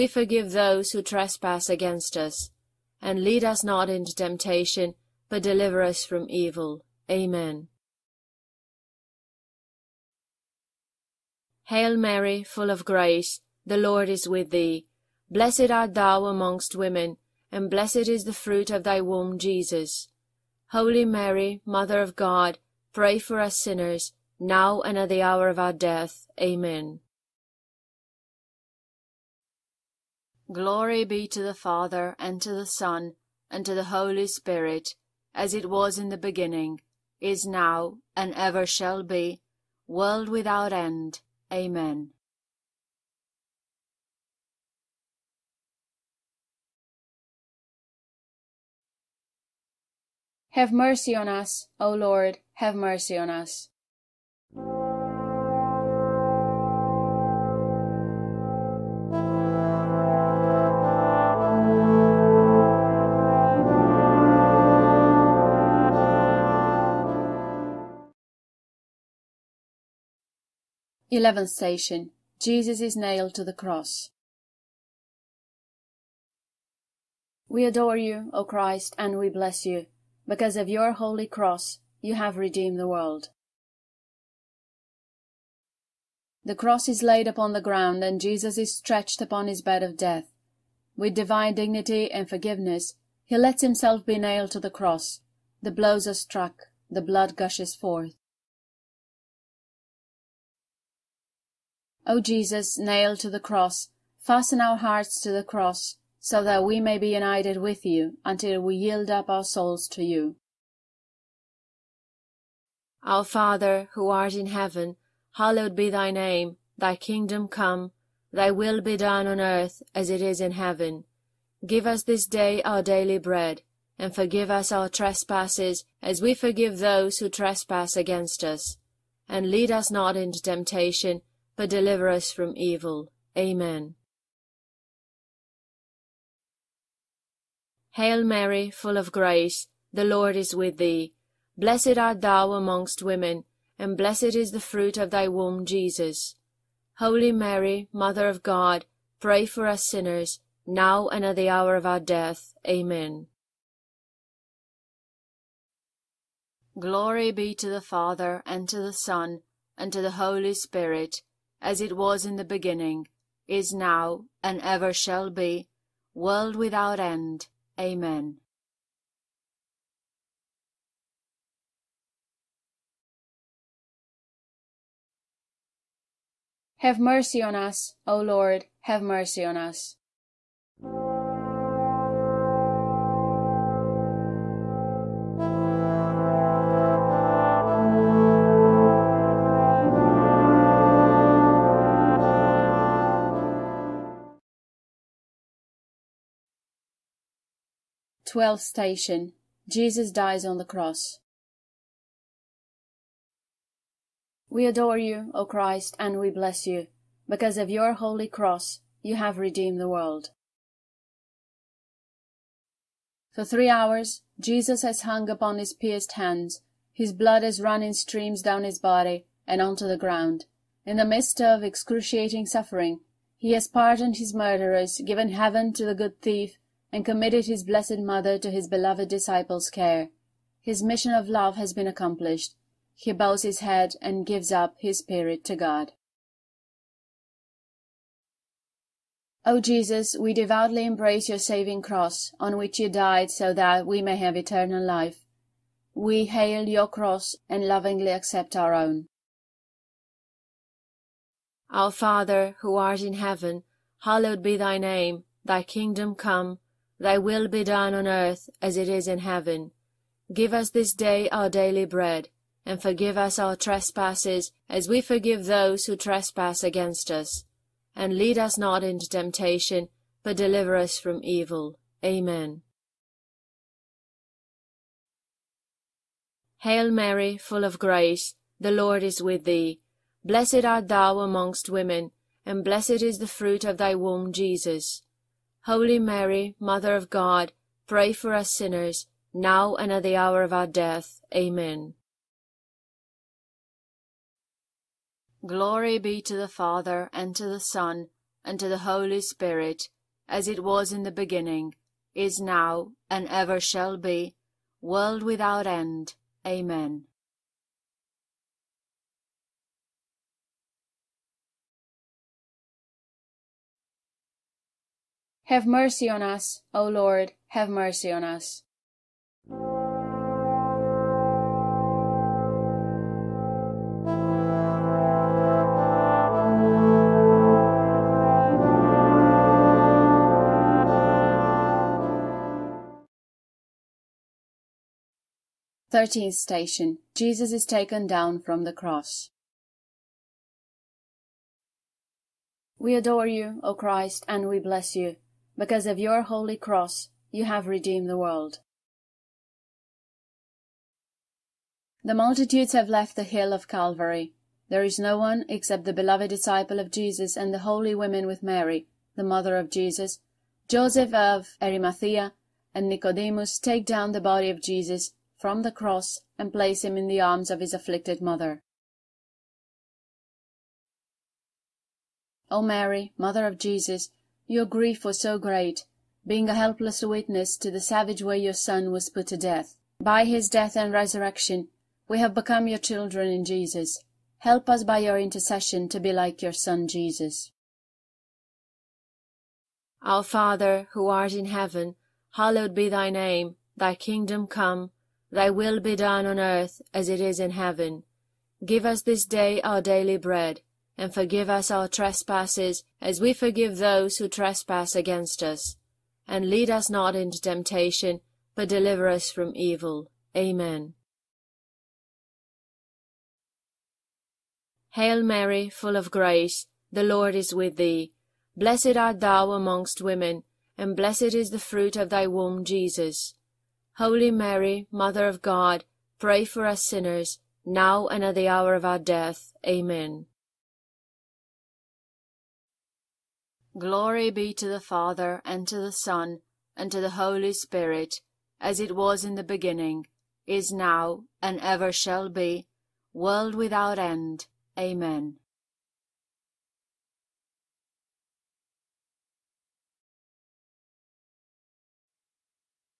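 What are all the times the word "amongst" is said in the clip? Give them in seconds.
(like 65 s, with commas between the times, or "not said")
16 s, 142 s, 281 s, 419 s.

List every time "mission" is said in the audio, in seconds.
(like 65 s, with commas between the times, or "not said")
230 s.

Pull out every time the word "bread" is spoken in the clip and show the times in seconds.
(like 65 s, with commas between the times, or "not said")
123 s, 261 s, 400 s.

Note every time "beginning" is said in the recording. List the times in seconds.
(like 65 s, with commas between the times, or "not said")
36 s, 162 s, 301 s, 439 s.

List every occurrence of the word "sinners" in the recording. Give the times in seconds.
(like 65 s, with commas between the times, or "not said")
23 s, 149 s, 288 s, 426 s.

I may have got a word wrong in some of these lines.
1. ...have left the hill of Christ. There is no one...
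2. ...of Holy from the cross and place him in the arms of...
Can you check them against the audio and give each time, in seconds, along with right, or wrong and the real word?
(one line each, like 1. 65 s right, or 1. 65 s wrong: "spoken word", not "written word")
1. 352 s wrong: "Calvary", not "Christ"
2. 364 s wrong: "Jesus", not "Holy".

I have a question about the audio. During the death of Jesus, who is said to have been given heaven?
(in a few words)
the good thief.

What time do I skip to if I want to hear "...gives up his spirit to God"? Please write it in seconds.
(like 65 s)
234 s.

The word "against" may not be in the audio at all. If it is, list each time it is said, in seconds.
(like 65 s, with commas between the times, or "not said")
1 s, 127 s, 266 s, 404 s.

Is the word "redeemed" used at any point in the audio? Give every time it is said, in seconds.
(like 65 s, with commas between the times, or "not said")
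82 s, 209 s, 347 s.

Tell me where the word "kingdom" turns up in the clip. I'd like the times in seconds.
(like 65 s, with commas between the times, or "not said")
116 s, 255 s, 393 s.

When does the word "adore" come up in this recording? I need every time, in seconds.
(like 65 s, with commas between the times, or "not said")
77 s, 204 s, 342 s.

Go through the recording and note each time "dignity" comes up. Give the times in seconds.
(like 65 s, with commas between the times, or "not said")
91 s.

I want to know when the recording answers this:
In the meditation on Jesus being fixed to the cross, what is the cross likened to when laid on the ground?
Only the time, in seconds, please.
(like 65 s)
89 s.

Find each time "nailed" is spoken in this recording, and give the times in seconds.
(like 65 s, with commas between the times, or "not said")
72 s, 94 s, 102 s.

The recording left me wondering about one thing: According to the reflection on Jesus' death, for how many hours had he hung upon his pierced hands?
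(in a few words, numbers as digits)
3.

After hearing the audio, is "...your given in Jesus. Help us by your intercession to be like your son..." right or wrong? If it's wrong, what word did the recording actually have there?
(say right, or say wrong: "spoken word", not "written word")
wrong: "children", not "given".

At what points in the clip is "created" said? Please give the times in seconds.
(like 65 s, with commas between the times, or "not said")
not said.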